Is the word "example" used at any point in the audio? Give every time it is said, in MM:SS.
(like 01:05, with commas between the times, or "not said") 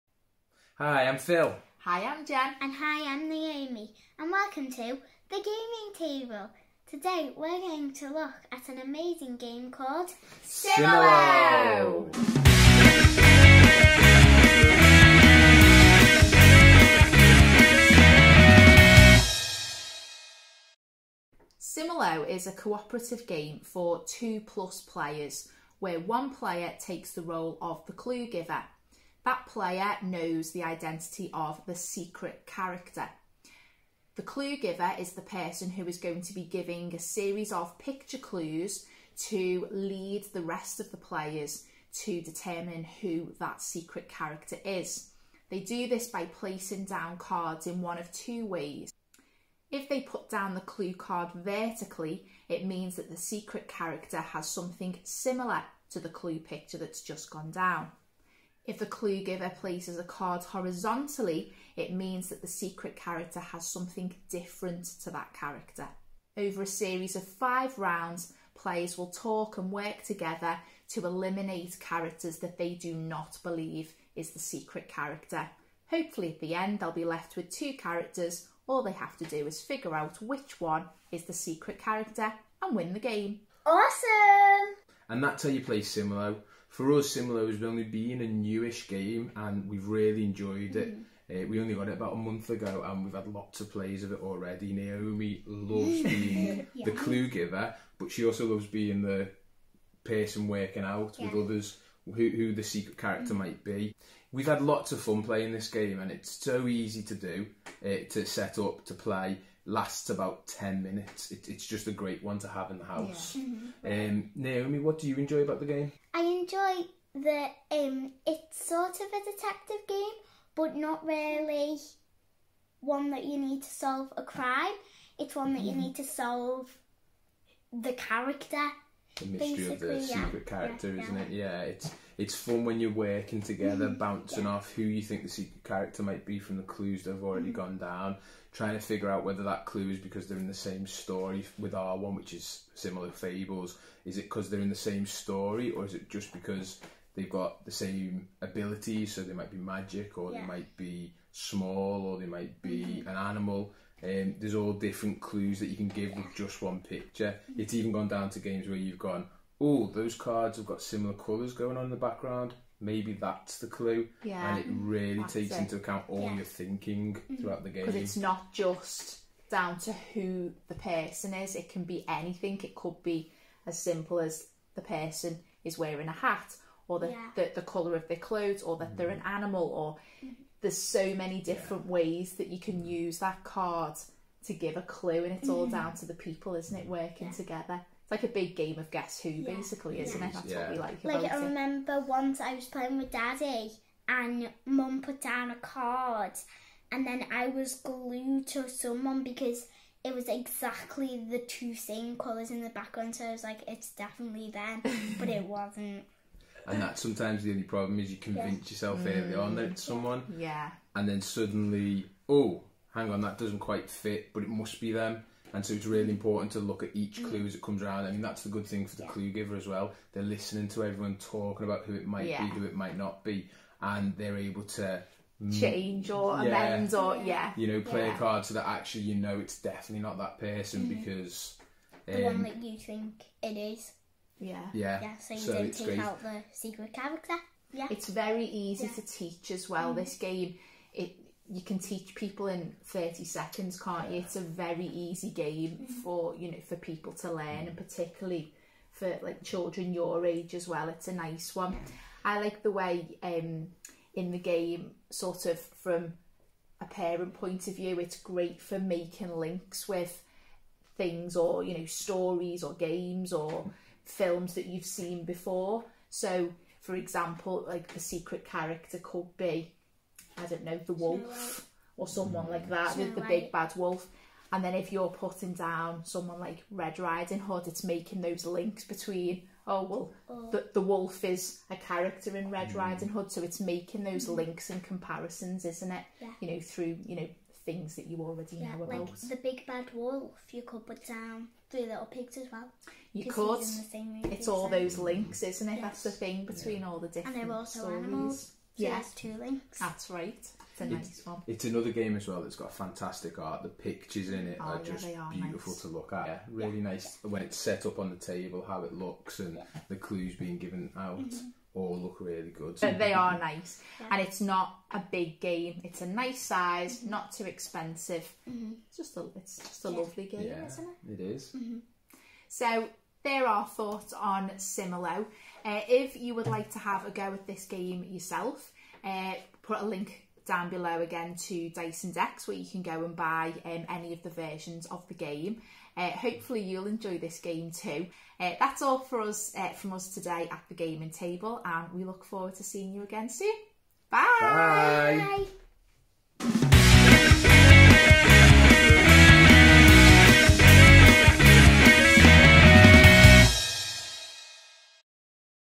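04:26.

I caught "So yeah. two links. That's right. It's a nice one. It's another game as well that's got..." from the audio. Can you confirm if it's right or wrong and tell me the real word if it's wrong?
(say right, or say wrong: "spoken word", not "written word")
right.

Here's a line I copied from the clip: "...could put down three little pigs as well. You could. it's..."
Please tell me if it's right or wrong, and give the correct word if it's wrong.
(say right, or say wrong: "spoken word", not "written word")
right.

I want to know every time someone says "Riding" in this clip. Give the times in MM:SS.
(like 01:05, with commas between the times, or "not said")
04:36, 04:42.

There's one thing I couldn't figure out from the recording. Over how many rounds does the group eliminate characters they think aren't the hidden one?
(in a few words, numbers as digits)
5.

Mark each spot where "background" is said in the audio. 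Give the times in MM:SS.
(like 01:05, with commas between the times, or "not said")
02:41, 03:22.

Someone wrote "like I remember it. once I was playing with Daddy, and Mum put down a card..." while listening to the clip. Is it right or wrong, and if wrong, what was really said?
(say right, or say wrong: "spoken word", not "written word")
right.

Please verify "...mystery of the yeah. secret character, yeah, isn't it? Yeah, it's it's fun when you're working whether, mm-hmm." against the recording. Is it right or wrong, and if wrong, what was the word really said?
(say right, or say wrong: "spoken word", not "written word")
wrong: "together", not "whether".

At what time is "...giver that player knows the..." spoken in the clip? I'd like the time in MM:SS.
00:28.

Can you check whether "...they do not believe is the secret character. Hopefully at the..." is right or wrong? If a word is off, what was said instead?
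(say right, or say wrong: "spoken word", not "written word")
right.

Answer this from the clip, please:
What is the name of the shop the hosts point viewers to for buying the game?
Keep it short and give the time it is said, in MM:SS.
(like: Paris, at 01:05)
Dice and Decks, at 05:31.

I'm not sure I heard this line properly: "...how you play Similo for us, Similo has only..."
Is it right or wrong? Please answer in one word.
right.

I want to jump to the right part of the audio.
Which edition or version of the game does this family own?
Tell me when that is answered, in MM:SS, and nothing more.
02:22.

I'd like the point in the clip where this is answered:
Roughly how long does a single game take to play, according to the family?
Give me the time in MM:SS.
01:50.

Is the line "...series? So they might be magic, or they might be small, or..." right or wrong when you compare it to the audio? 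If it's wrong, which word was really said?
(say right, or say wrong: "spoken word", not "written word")
wrong: "abilities", not "series".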